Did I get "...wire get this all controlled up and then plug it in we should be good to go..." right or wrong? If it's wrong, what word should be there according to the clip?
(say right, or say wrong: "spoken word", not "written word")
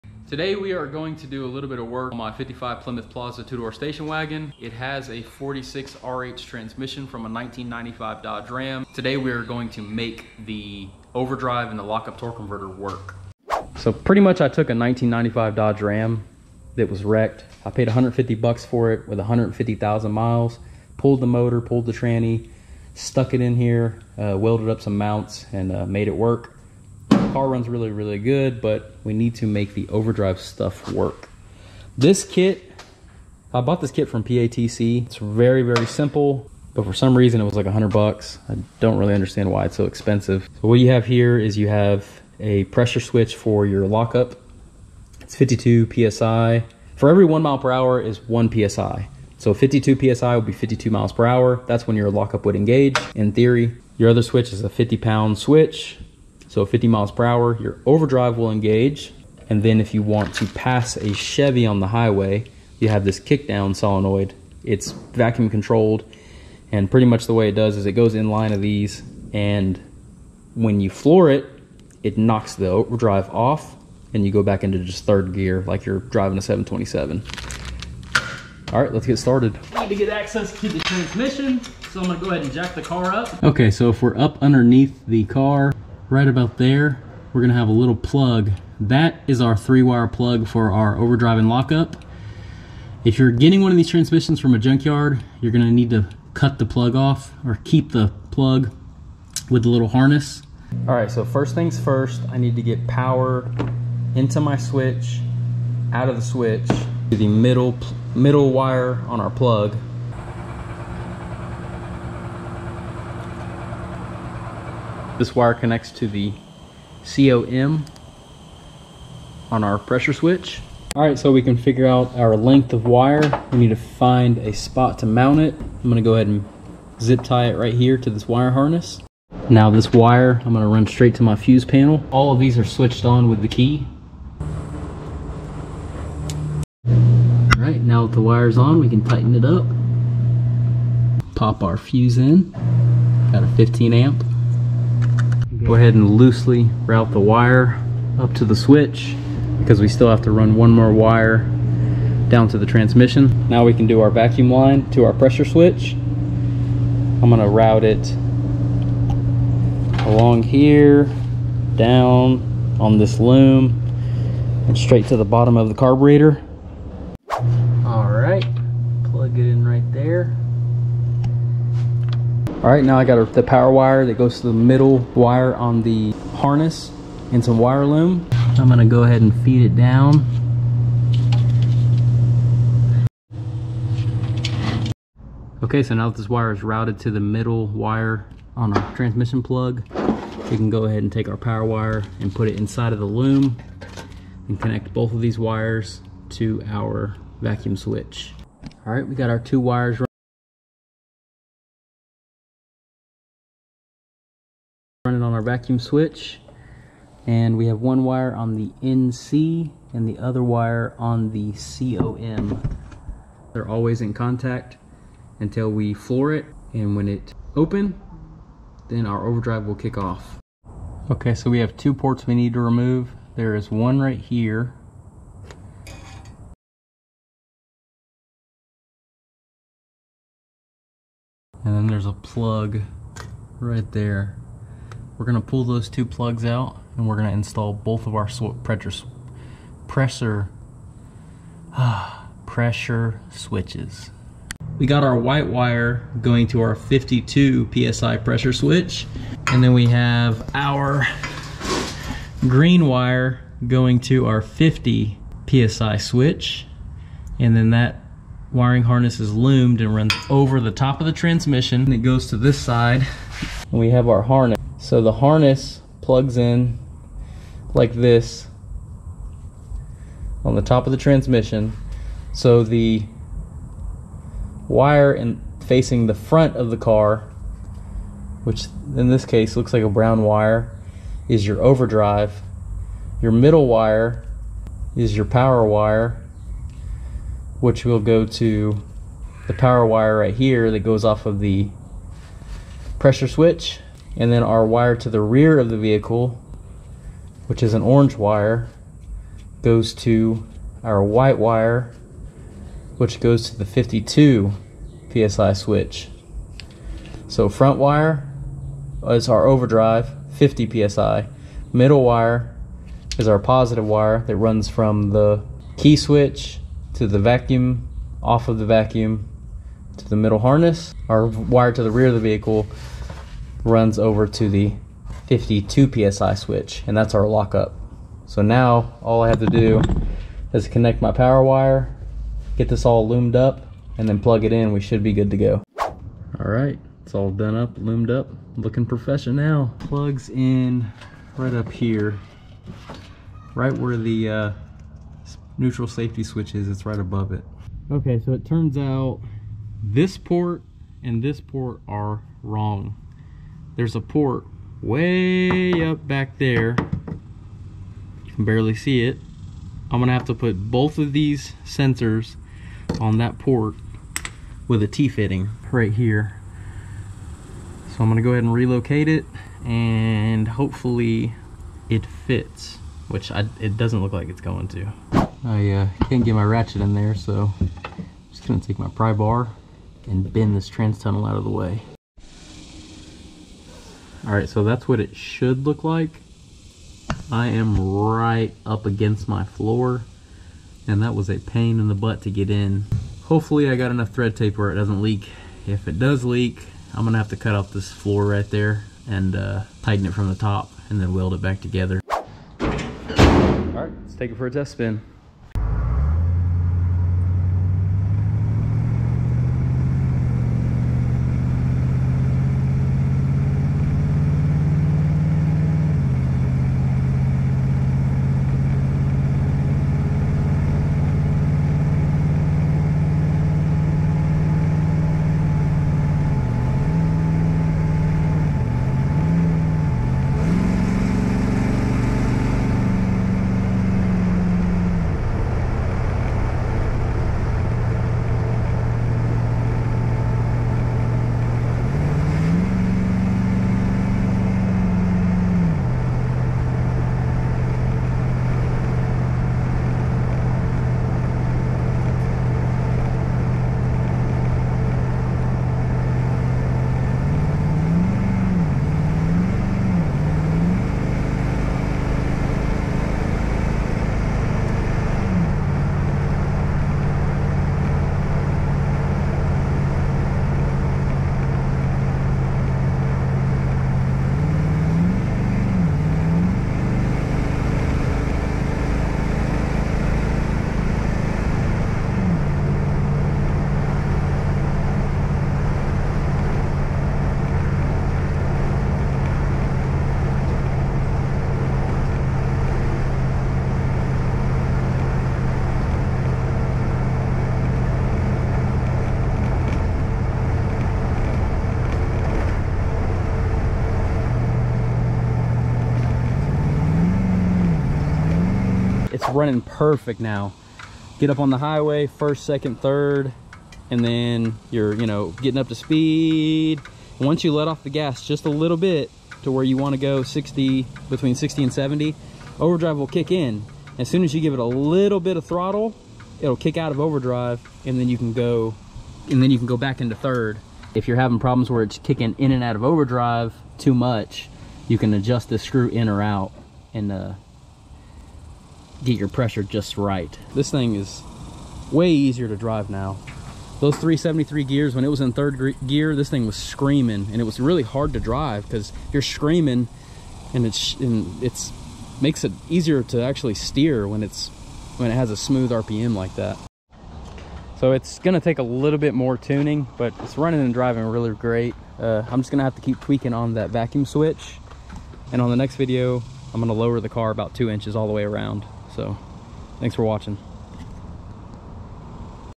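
wrong: "loomed", not "controlled".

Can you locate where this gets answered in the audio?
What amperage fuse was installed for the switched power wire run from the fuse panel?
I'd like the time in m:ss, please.
2:23.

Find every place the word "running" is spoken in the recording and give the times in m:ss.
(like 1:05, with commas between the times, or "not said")
8:29, 9:20.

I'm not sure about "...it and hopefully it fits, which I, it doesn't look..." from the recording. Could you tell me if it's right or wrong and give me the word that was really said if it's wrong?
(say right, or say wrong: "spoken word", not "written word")
right.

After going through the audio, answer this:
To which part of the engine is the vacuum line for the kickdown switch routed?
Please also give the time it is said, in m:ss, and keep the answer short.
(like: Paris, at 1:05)
the carburetor, at 2:45.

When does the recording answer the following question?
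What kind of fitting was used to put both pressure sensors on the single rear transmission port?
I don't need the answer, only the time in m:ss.
6:04.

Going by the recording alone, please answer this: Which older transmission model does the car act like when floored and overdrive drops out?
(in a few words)
727.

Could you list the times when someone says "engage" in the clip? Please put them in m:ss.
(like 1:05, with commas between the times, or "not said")
0:52, 0:58.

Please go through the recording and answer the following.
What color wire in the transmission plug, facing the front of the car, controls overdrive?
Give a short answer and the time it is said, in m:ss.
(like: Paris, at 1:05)
brown, at 4:39.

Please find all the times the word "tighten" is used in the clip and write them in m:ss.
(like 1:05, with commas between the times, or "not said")
2:19, 6:39.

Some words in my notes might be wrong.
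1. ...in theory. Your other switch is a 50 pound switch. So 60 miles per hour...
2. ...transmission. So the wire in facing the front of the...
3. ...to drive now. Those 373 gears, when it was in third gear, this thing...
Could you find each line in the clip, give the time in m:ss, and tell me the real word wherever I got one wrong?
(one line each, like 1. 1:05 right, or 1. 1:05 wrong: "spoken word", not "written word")
1. 0:53 wrong: "50", not "60"
2. 4:30 right
3. 9:02 right.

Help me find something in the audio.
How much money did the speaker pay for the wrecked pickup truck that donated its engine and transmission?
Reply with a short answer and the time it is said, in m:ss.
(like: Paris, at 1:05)
$150, at 0:17.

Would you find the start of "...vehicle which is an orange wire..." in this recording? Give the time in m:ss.
4:55.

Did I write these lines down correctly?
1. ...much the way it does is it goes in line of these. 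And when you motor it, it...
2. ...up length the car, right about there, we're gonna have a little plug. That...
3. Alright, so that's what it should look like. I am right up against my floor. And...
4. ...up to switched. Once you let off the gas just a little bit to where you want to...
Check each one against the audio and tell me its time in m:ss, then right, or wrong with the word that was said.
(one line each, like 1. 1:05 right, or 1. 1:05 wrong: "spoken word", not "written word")
1. 1:07 wrong: "floor", not "motor"
2. 1:24 wrong: "underneath", not "length"
3. 6:24 right
4. 8:35 wrong: "speed", not "switched".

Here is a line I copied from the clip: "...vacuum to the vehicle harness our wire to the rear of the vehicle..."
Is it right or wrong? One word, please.
wrong.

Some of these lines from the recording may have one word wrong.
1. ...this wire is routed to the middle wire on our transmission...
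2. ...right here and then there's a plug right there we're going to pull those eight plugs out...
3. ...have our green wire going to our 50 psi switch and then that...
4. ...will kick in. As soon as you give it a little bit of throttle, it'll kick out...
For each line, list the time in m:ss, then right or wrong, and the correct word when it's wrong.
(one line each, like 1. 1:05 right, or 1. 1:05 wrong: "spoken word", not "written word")
1. 3:06 right
2. 3:43 wrong: "two", not "eight"
3. 4:09 right
4. 8:42 right.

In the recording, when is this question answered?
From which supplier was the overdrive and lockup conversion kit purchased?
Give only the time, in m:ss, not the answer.
0:34.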